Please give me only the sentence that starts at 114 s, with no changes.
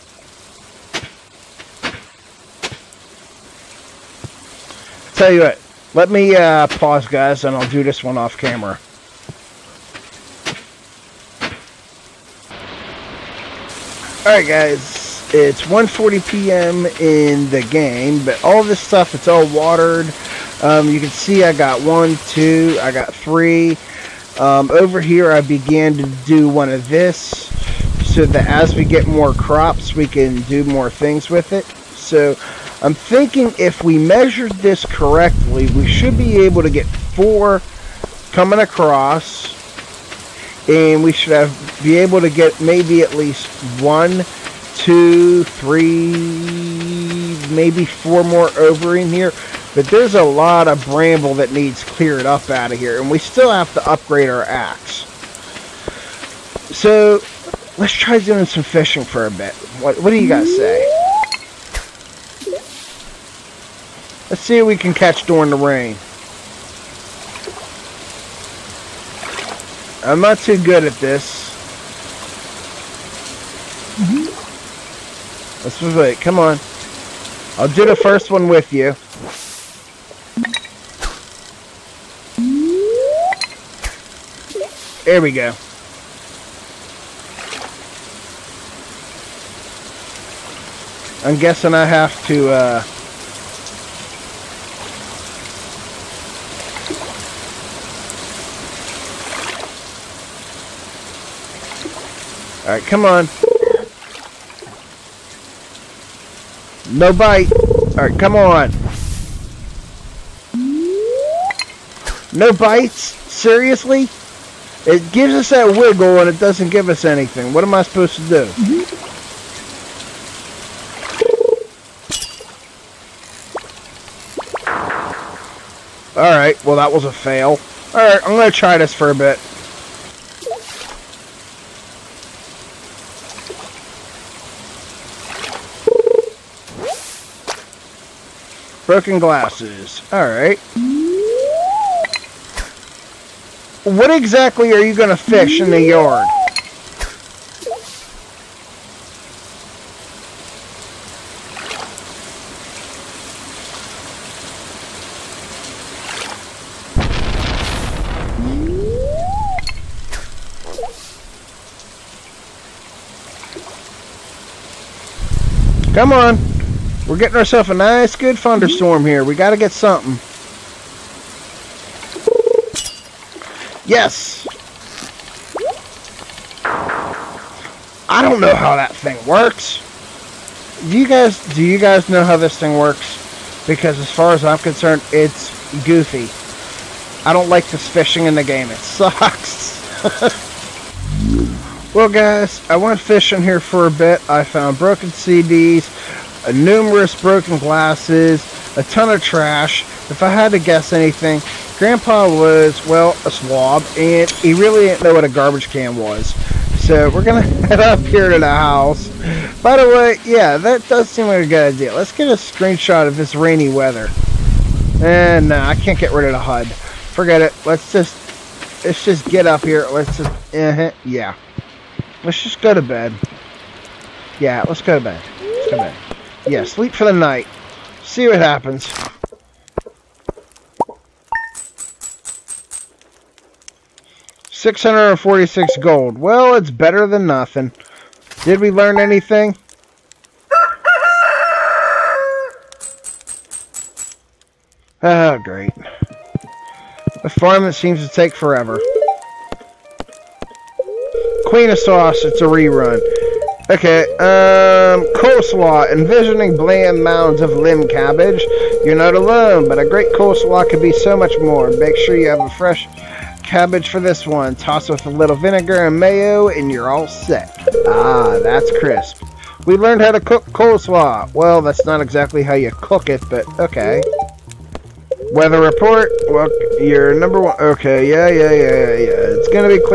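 It gives us that wiggle and it doesn't give us anything.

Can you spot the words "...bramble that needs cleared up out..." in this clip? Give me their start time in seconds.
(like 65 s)
50 s.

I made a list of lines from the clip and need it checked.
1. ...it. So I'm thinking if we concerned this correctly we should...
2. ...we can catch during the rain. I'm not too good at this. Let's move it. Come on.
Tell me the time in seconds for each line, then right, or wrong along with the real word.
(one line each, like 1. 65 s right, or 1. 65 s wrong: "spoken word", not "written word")
1. 31 s wrong: "measured", not "concerned"
2. 64 s right.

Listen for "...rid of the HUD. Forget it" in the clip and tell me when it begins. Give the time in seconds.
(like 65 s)
216 s.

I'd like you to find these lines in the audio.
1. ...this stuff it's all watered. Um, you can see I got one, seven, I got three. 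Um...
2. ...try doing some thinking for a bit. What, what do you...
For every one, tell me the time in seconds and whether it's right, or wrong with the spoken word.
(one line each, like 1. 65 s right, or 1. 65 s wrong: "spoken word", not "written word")
1. 18 s wrong: "two", not "seven"
2. 57 s wrong: "fishing", not "thinking".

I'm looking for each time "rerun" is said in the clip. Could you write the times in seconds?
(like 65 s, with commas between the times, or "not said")
252 s.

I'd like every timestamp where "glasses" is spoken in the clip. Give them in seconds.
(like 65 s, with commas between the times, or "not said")
139 s, 197 s.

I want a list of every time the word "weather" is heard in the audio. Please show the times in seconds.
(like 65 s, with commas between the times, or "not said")
213 s, 275 s.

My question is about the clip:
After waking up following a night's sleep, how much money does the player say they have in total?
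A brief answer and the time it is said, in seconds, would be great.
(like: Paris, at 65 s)
646 gold, at 234 s.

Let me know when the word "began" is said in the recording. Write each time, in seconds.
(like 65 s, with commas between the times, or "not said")
25 s.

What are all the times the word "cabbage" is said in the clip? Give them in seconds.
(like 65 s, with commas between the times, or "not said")
257 s, 263 s.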